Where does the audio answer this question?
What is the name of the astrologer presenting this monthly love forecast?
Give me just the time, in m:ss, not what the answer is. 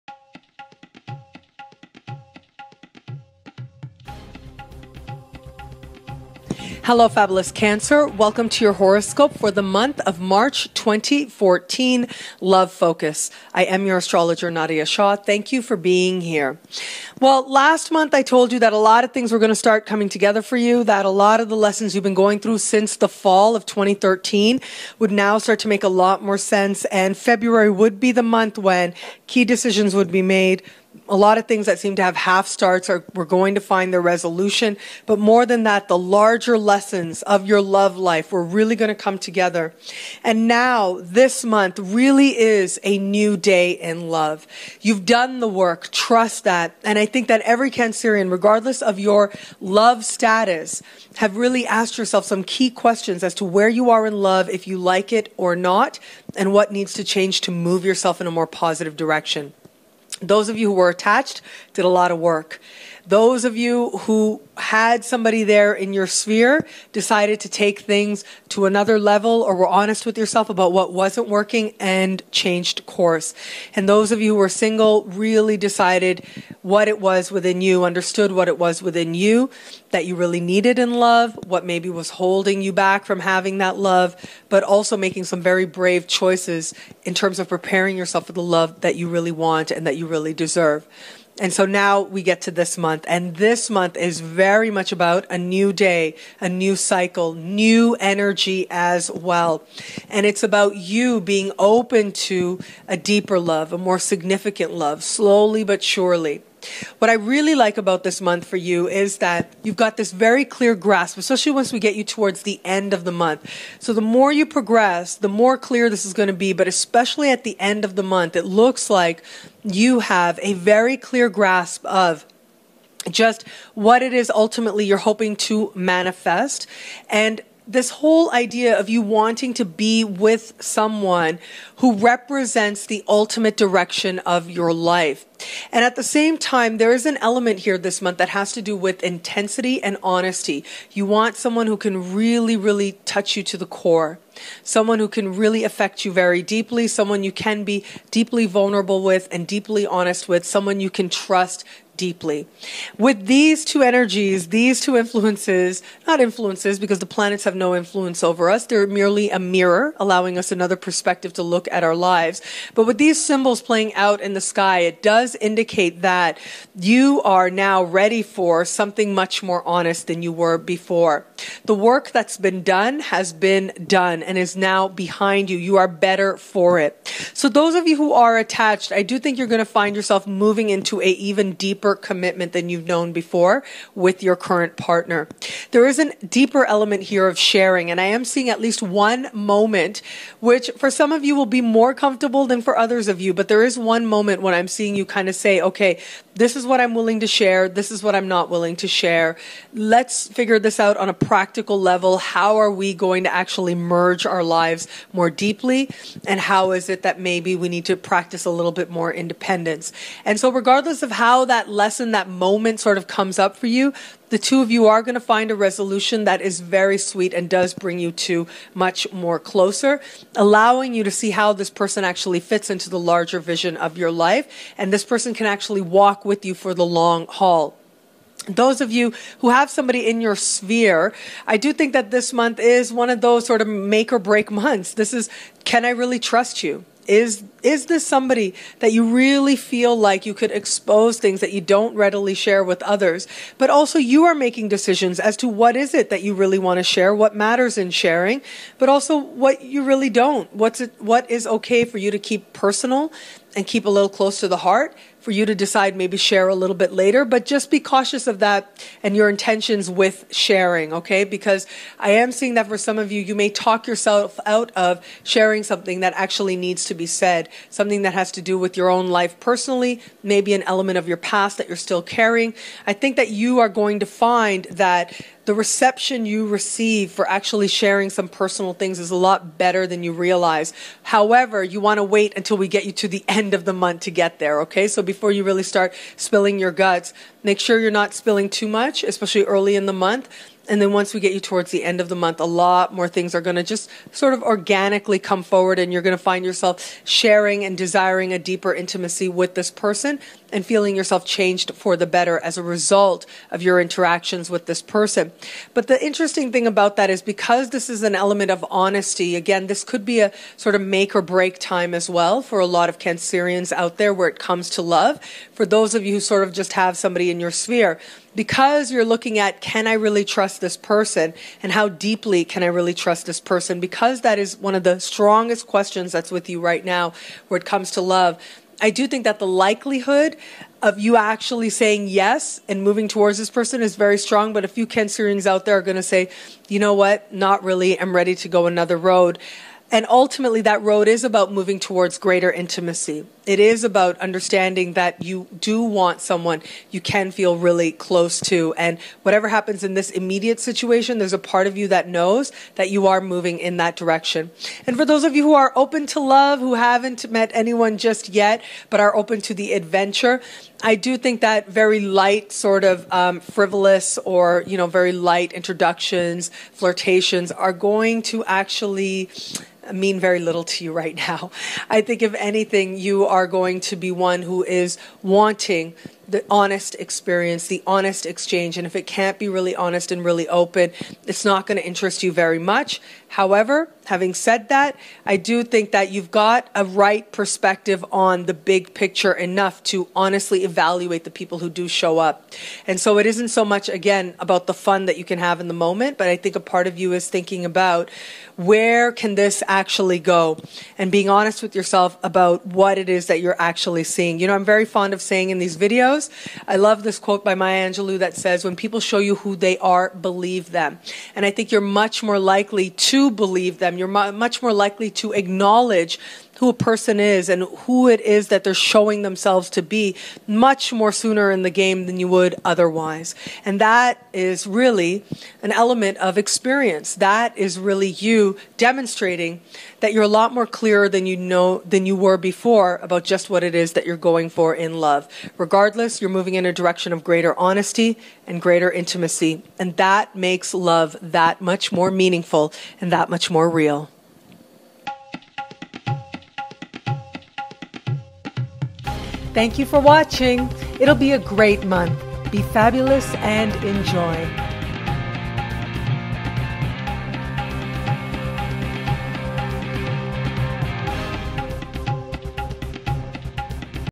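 0:14.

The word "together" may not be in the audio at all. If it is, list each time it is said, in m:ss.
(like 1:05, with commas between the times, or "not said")
0:20, 0:39.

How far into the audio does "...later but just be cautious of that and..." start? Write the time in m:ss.
4:16.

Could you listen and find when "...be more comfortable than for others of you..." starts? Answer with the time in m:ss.
3:11.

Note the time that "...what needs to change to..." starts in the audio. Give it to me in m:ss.
0:56.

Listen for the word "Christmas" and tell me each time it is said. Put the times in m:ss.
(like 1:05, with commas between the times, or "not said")
not said.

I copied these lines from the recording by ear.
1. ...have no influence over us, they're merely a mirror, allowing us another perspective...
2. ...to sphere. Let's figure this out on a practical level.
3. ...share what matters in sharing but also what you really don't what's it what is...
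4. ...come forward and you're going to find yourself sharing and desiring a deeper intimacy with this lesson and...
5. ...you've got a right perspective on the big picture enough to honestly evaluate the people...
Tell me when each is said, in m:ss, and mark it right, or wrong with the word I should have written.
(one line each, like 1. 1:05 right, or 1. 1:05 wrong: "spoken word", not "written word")
1. 2:37 right
2. 3:18 wrong: "share", not "sphere"
3. 4:06 right
4. 4:55 wrong: "person", not "lesson"
5. 6:26 right.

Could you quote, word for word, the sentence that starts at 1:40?
And it's about you being open to a deeper love, a more significant love, slowly but surely.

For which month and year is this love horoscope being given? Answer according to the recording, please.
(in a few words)
March 2014.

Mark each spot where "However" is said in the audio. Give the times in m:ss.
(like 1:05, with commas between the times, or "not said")
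4:41, 6:23.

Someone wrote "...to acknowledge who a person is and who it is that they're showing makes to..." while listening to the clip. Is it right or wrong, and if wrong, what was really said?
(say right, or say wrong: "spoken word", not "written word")
wrong: "themselves", not "makes".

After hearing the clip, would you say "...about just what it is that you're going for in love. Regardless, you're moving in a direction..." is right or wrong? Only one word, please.
right.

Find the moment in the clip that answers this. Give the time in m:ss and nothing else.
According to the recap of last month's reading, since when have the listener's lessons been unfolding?
0:23.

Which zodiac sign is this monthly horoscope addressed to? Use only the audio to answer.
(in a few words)
Cancer.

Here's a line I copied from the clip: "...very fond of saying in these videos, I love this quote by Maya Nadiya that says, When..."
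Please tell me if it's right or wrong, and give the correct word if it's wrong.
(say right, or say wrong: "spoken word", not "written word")
wrong: "Angelou", not "Nadiya".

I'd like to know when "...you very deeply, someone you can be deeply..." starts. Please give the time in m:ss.
2:26.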